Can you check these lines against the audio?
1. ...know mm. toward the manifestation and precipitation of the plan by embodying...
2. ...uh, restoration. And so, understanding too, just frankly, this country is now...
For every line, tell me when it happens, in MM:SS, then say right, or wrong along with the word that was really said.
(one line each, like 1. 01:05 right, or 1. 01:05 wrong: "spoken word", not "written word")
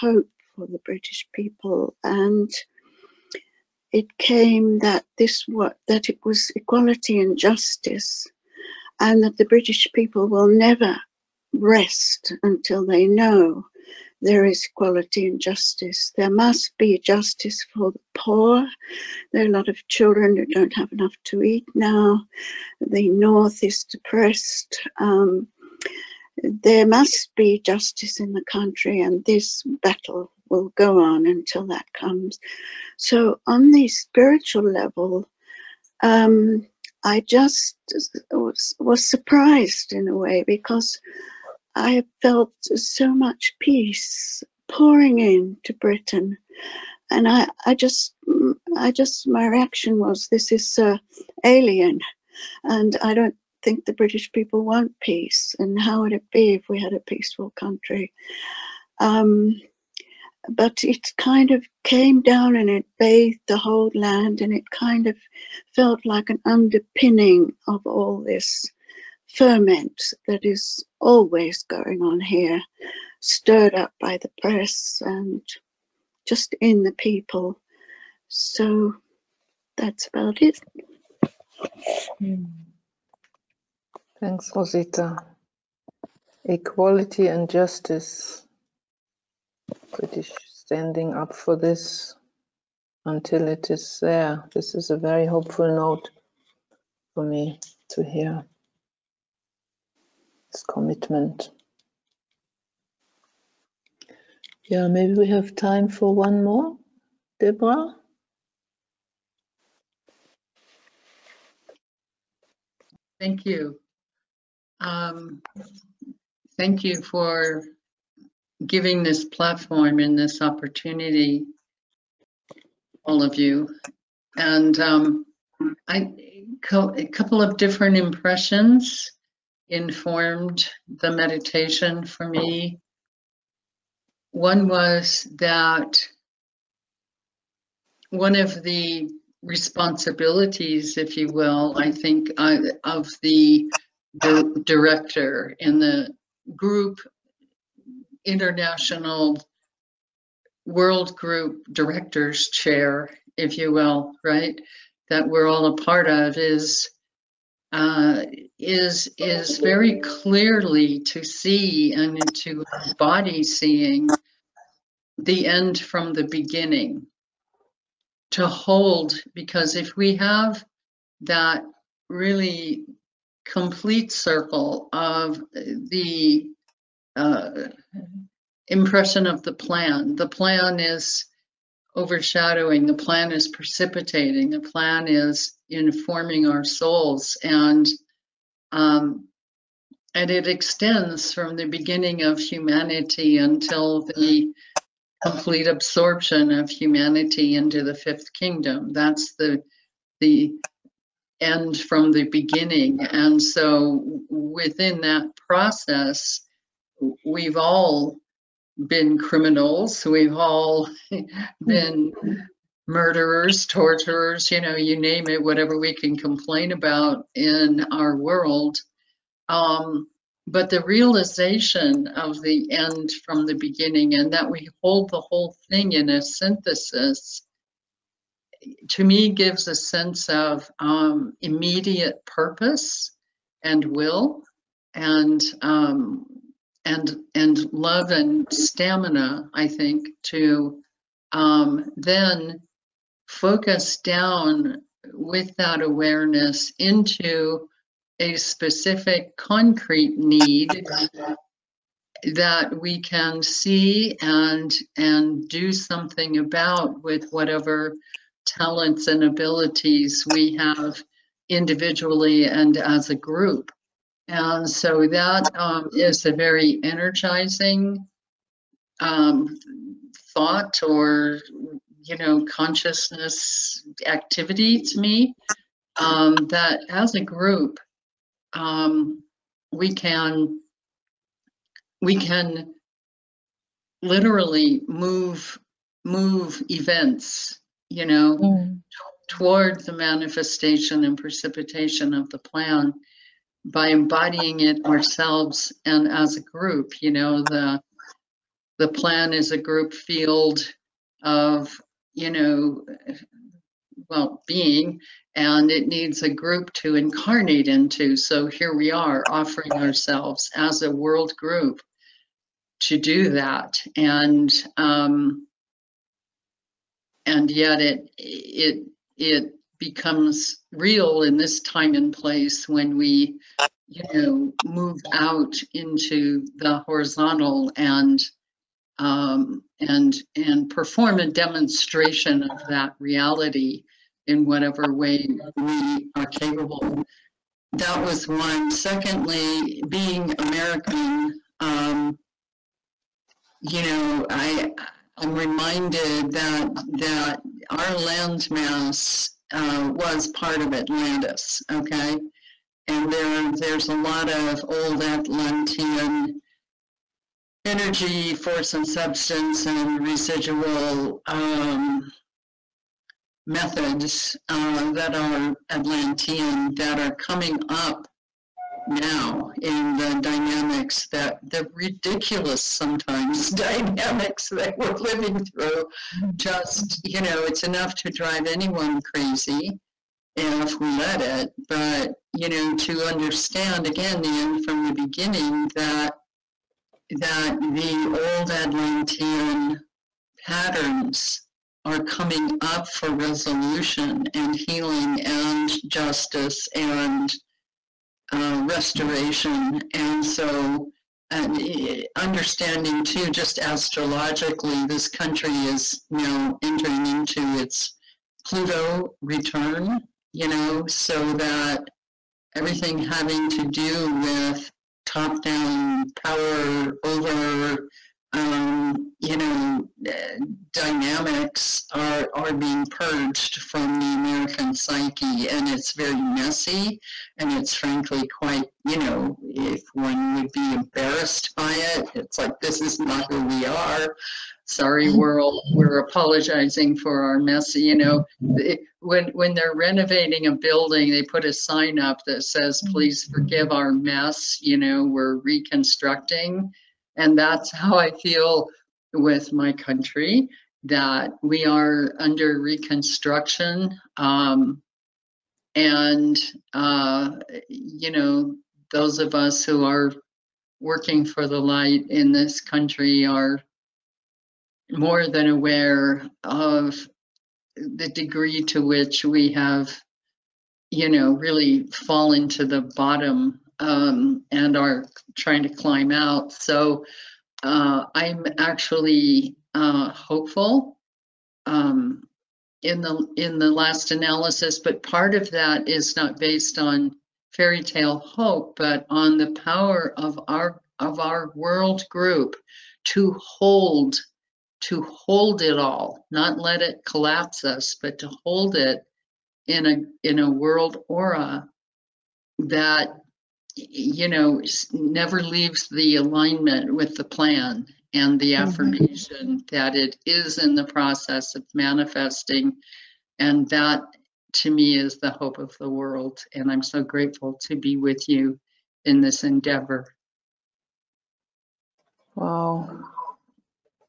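1. 04:48 right
2. 06:38 wrong: "astrologically", not "frankly".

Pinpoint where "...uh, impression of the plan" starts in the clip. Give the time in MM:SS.
02:57.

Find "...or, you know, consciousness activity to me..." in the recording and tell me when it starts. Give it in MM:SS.
04:30.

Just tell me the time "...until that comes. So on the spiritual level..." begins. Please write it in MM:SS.
00:31.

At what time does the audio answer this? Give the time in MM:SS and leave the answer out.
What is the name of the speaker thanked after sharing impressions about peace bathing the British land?
01:24.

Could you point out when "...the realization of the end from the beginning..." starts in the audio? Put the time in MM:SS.
03:40.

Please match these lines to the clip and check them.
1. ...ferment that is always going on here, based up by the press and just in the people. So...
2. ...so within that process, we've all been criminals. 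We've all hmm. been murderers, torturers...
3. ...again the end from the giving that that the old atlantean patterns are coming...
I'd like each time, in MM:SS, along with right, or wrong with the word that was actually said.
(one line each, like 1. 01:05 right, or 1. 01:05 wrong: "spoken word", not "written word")
1. 01:09 wrong: "stirred", not "based"
2. 03:23 right
3. 06:23 wrong: "beginning", not "giving".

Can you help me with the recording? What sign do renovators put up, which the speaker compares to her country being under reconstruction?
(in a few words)
Please forgive our mess.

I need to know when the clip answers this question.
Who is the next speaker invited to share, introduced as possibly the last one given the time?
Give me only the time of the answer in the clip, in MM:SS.
01:47.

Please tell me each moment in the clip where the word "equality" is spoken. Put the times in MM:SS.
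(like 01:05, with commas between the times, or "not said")
00:06, 00:14, 01:26.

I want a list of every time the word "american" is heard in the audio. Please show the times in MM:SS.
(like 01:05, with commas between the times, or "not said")
05:40, 07:04.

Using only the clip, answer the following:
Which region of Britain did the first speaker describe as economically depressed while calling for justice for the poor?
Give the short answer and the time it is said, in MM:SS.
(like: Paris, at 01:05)
The North, at 00:22.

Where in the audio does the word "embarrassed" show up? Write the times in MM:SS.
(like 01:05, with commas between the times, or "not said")
07:10.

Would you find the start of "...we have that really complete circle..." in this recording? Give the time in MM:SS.
02:49.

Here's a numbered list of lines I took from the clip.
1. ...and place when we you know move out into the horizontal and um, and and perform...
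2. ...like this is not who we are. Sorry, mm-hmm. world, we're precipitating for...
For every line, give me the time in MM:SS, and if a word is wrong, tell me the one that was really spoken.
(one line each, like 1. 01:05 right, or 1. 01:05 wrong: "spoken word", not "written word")
1. 05:21 right
2. 07:12 wrong: "apologizing", not "precipitating".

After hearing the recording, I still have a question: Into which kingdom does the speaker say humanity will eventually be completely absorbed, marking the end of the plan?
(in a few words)
The fifth kingdom.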